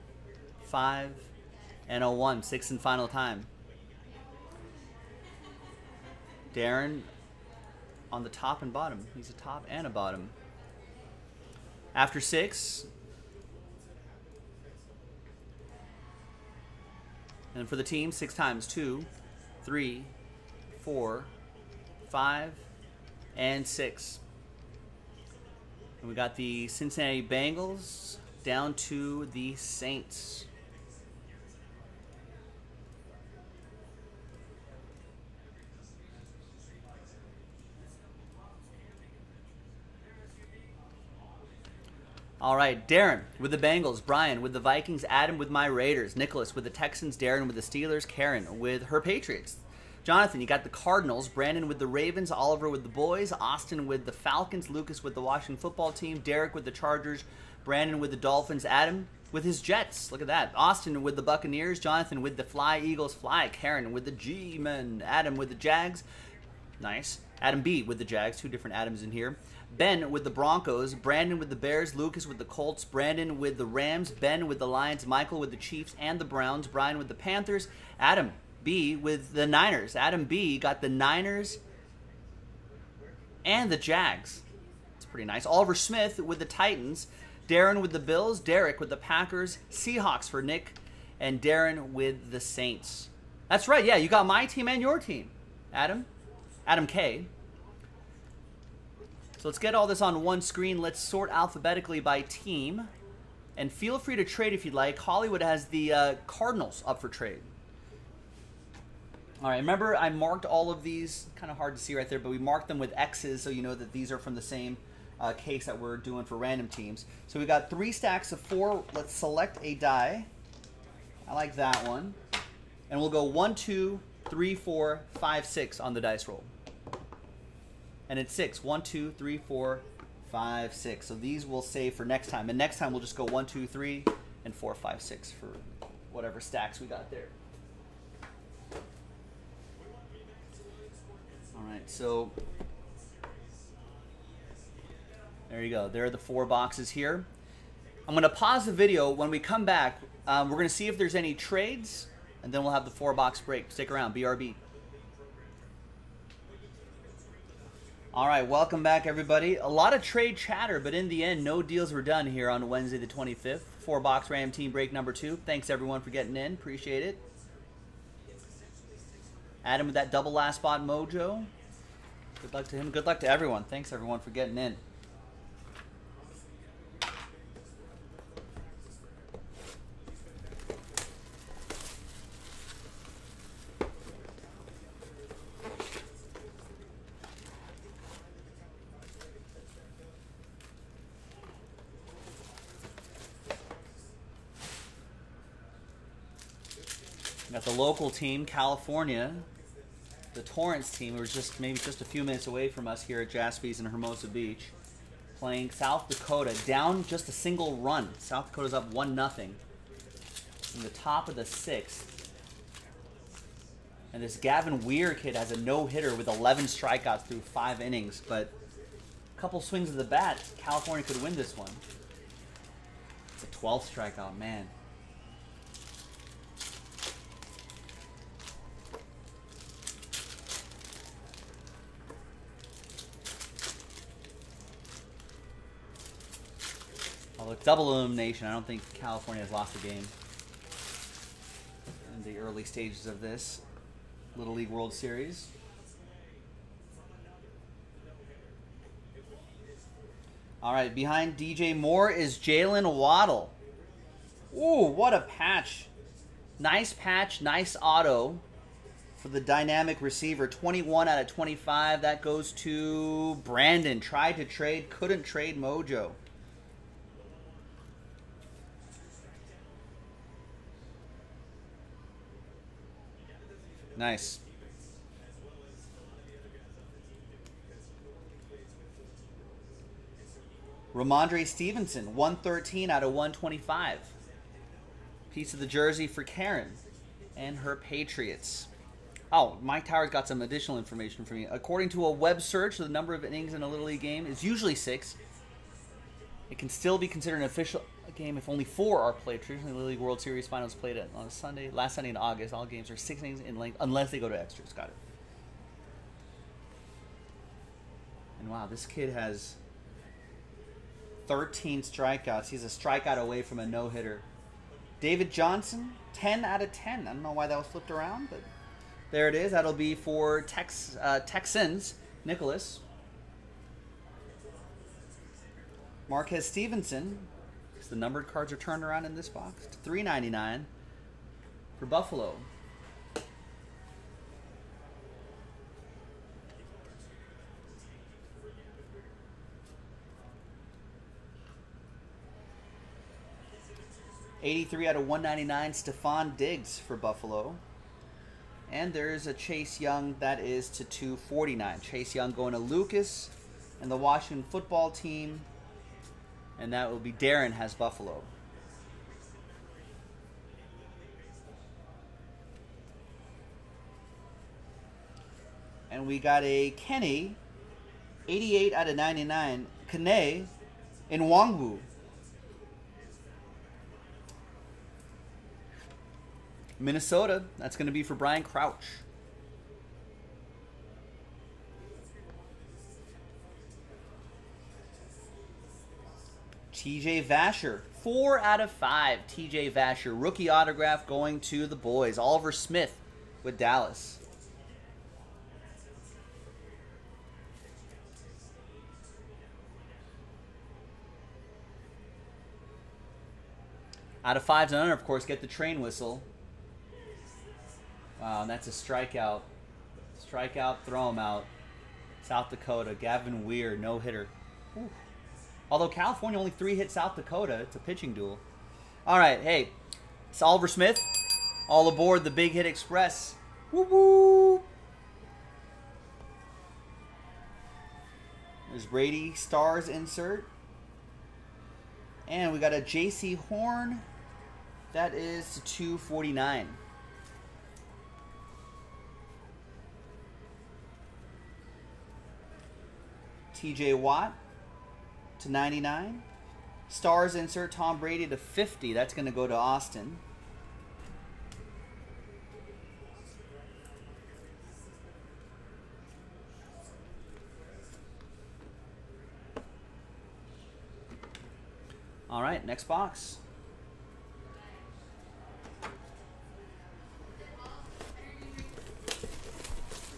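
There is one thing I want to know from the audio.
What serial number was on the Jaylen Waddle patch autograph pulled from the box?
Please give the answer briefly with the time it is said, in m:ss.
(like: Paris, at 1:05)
21 out of 25, at 4:20.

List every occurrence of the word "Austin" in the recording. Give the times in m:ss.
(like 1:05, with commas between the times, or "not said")
0:53, 1:00, 7:29.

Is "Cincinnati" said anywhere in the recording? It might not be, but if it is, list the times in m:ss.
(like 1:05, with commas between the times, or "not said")
0:26.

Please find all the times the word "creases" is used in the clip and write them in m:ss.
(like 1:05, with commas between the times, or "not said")
not said.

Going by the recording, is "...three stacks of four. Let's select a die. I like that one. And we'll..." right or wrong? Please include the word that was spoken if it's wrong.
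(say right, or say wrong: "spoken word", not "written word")
right.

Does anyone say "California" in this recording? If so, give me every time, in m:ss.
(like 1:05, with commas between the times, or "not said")
3:18, 3:40, 3:58, 6:55.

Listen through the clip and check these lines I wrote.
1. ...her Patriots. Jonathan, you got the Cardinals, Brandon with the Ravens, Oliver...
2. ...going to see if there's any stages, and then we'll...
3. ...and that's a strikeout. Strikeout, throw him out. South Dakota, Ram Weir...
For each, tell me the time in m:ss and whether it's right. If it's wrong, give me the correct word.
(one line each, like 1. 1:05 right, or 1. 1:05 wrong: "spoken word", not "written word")
1. 0:48 right
2. 2:30 wrong: "trades", not "stages"
3. 6:48 wrong: "Gavin", not "Ram".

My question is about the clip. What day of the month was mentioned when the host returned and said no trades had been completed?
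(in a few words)
25th.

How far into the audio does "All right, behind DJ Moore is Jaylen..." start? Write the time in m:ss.
4:10.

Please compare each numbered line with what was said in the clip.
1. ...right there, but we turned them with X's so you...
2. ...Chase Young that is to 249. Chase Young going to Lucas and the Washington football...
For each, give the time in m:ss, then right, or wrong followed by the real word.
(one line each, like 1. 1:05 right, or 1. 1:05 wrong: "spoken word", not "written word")
1. 1:51 wrong: "marked", not "turned"
2. 5:49 right.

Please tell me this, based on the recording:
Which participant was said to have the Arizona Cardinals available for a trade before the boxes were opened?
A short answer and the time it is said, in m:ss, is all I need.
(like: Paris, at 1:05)
Hollywood, at 1:44.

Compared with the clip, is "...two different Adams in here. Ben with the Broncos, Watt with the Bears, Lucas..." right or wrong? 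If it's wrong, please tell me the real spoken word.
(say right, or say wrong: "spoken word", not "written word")
wrong: "Brandon", not "Watt".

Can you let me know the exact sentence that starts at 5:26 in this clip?
Marquez Stevenson, the numbered cards are turned around in this box to three ninety nine for Buffalo.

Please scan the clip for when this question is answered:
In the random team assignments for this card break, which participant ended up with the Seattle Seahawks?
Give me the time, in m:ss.
1:29.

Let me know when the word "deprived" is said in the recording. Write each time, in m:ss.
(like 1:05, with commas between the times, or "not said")
not said.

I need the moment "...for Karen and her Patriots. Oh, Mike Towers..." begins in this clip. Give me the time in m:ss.
4:46.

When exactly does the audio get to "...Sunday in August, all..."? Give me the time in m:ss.
5:01.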